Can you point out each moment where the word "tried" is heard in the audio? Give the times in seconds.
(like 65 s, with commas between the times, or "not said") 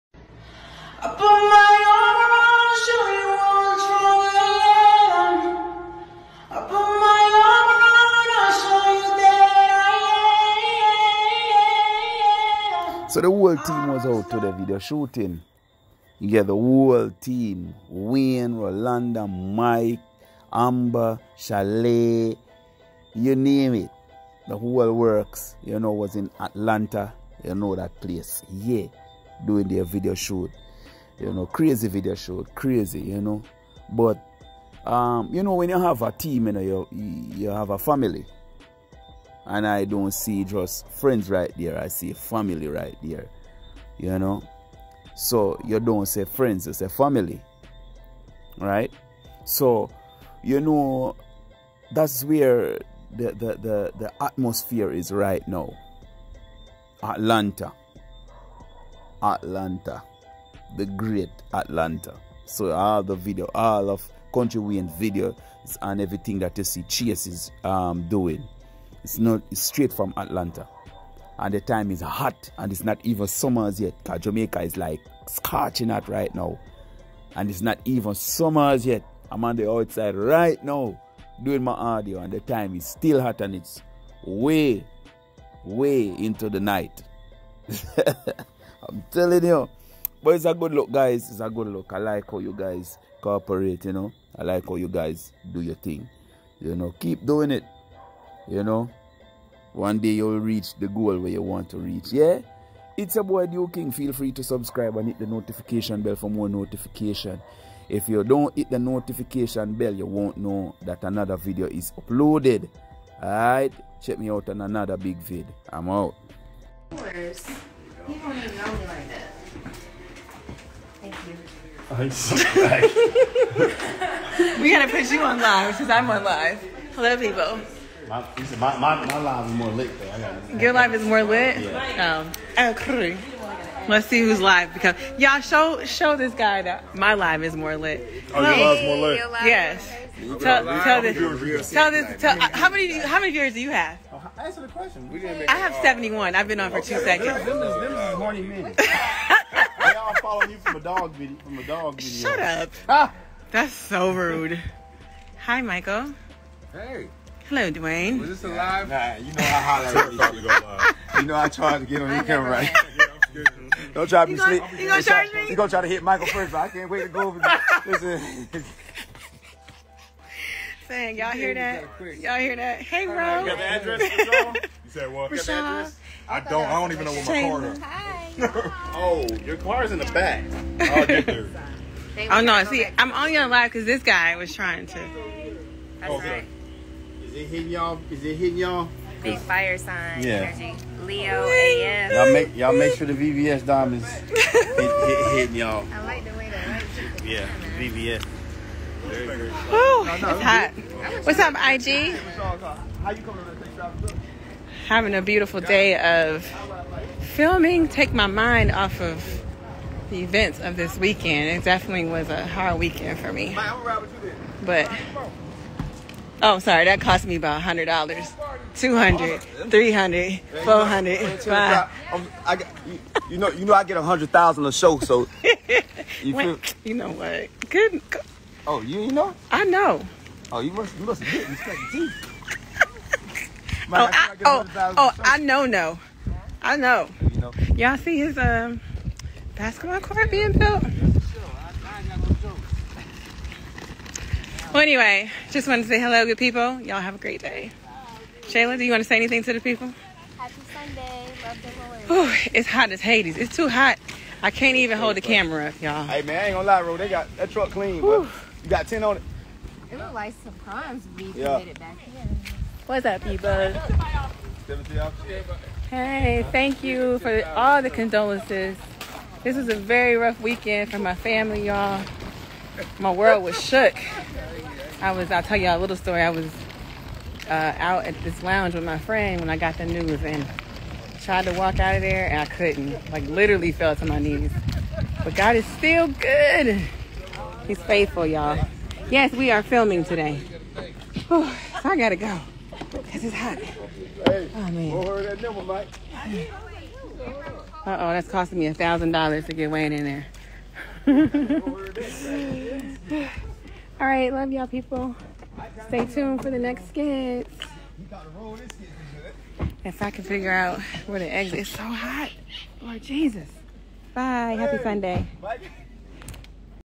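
161 s, 281 s.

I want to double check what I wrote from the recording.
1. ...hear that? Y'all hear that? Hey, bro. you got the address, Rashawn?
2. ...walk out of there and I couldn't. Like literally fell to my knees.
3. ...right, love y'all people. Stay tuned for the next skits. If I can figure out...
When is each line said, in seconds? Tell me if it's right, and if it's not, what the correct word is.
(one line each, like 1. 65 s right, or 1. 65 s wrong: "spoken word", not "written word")
1. 171 s right
2. 281 s right
3. 304 s right.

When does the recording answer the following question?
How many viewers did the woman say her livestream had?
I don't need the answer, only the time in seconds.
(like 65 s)
145 s.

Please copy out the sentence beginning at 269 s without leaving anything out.
This was a very rough weekend for my family, y'all.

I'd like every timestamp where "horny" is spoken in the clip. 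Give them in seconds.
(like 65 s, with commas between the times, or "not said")
148 s.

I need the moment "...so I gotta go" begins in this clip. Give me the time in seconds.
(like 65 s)
291 s.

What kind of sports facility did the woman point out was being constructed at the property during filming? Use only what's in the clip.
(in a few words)
basketball court.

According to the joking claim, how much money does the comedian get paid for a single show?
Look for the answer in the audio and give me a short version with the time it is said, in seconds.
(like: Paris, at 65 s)
100000, at 223 s.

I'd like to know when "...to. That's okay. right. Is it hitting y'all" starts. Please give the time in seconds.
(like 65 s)
184 s.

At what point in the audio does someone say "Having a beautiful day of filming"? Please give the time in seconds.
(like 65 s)
204 s.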